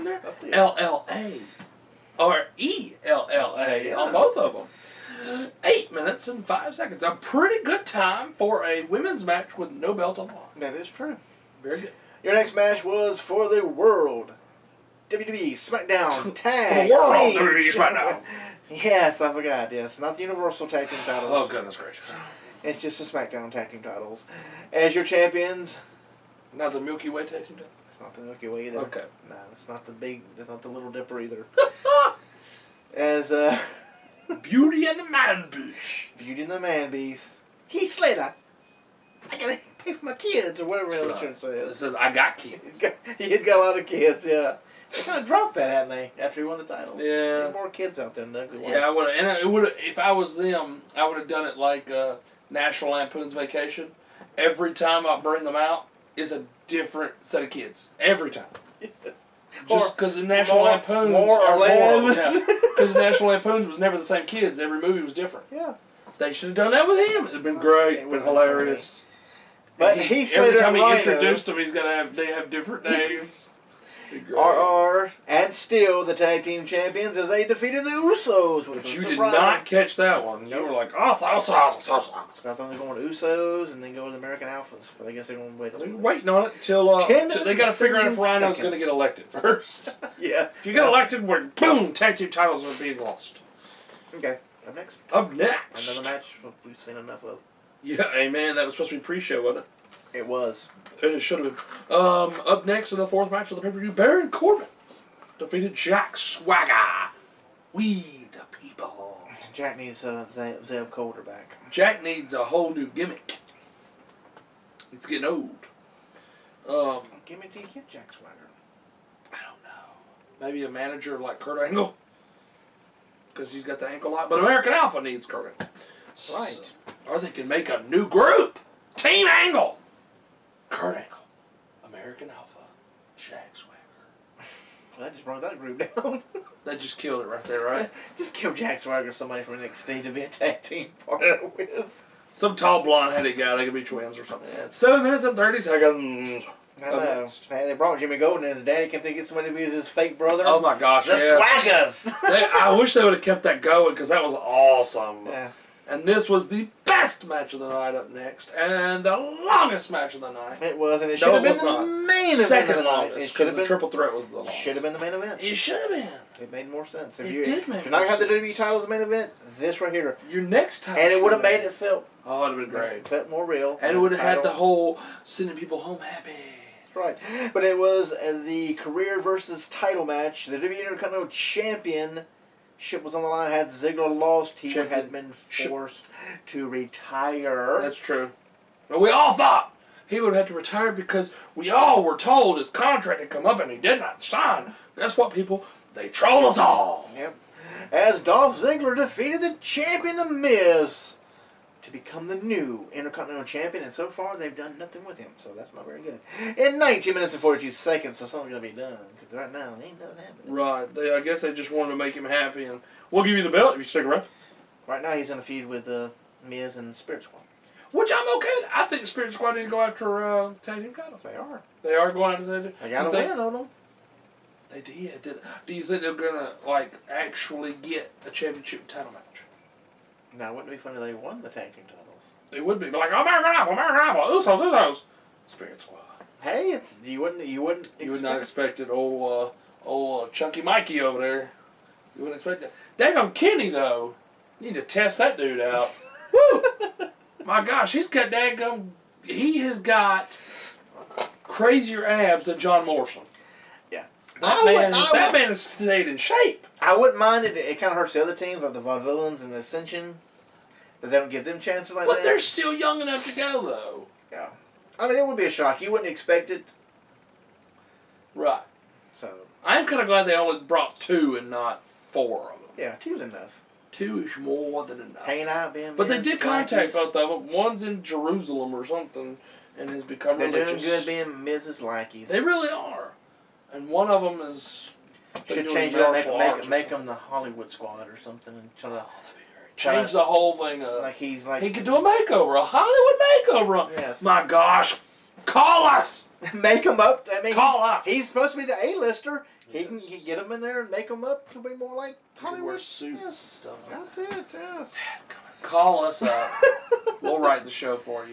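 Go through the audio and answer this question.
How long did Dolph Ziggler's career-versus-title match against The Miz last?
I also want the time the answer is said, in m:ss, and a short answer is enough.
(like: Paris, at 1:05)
19 minutes 42 seconds, at 3:26.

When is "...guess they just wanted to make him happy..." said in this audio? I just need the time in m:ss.
3:31.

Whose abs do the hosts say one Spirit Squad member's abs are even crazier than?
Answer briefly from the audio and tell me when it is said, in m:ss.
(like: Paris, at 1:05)
John Morrison, at 4:12.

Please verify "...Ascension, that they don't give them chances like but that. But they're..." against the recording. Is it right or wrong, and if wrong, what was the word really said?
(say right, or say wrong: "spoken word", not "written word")
right.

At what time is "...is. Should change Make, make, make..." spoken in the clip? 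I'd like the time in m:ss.
4:44.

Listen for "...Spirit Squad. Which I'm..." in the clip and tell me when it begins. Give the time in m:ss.
3:36.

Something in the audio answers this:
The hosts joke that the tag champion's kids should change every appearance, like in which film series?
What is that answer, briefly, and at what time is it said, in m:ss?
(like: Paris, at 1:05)
National Lampoon's Vacation, at 0:52.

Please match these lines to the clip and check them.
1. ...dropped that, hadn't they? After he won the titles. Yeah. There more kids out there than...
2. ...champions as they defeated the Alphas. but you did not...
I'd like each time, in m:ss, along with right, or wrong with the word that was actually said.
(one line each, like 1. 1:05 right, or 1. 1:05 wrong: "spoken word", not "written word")
1. 0:45 right
2. 1:16 wrong: "Usos", not "Alphas".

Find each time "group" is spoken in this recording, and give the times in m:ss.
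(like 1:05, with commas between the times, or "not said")
2:08, 2:15.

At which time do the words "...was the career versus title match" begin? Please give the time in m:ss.
2:57.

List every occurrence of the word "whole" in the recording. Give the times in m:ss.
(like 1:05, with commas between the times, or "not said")
1:52, 2:54, 4:50.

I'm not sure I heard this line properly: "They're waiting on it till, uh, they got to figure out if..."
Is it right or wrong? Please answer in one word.
right.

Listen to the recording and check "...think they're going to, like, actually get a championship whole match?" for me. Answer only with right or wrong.
wrong.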